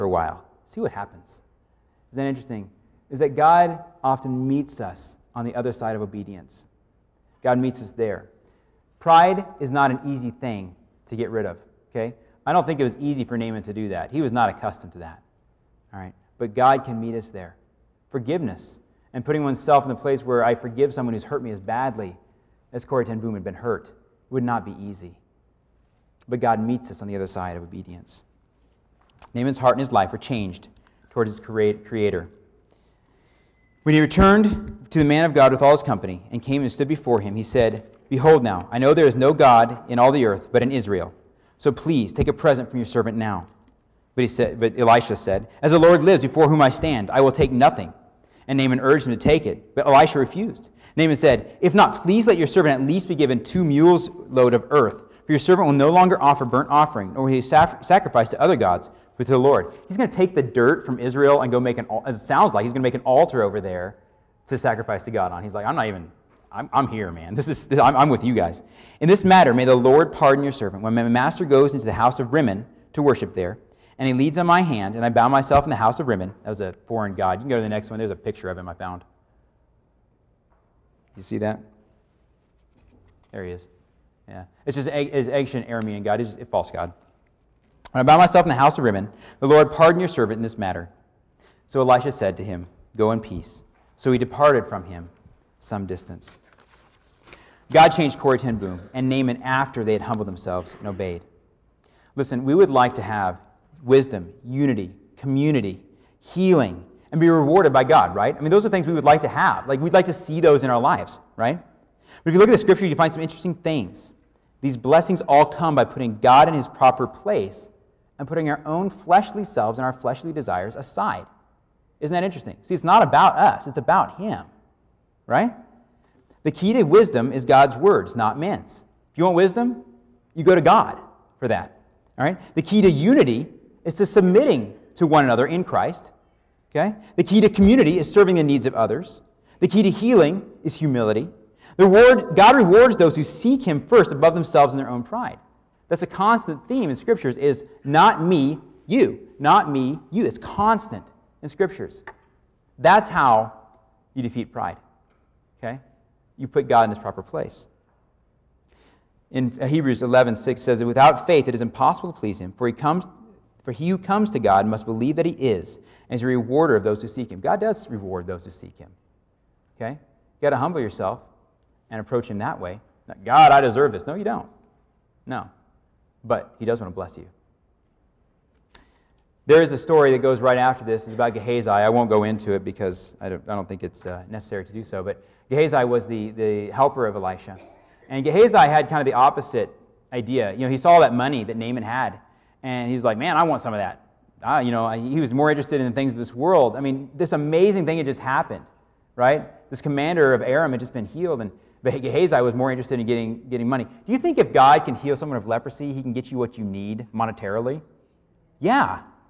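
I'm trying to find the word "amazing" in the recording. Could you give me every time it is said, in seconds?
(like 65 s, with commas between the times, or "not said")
197 s.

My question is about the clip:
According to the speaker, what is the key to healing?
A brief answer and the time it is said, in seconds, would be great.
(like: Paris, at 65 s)
Humility, at 140 s.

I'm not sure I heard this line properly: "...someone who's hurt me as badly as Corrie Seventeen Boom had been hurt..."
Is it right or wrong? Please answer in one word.
wrong.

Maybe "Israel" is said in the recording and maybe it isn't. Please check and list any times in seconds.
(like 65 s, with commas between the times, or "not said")
40 s, 60 s.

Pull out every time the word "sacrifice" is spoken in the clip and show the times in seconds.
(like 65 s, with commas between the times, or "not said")
57 s, 64 s.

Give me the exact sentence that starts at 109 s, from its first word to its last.
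Like, we'd like to see those in our lives, right?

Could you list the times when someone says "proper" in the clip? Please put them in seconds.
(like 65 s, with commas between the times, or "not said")
116 s, 156 s.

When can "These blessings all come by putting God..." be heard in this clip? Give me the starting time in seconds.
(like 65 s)
114 s.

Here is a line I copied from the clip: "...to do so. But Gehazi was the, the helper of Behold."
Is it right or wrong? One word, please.
wrong.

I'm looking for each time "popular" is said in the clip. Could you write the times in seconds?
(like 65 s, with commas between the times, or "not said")
not said.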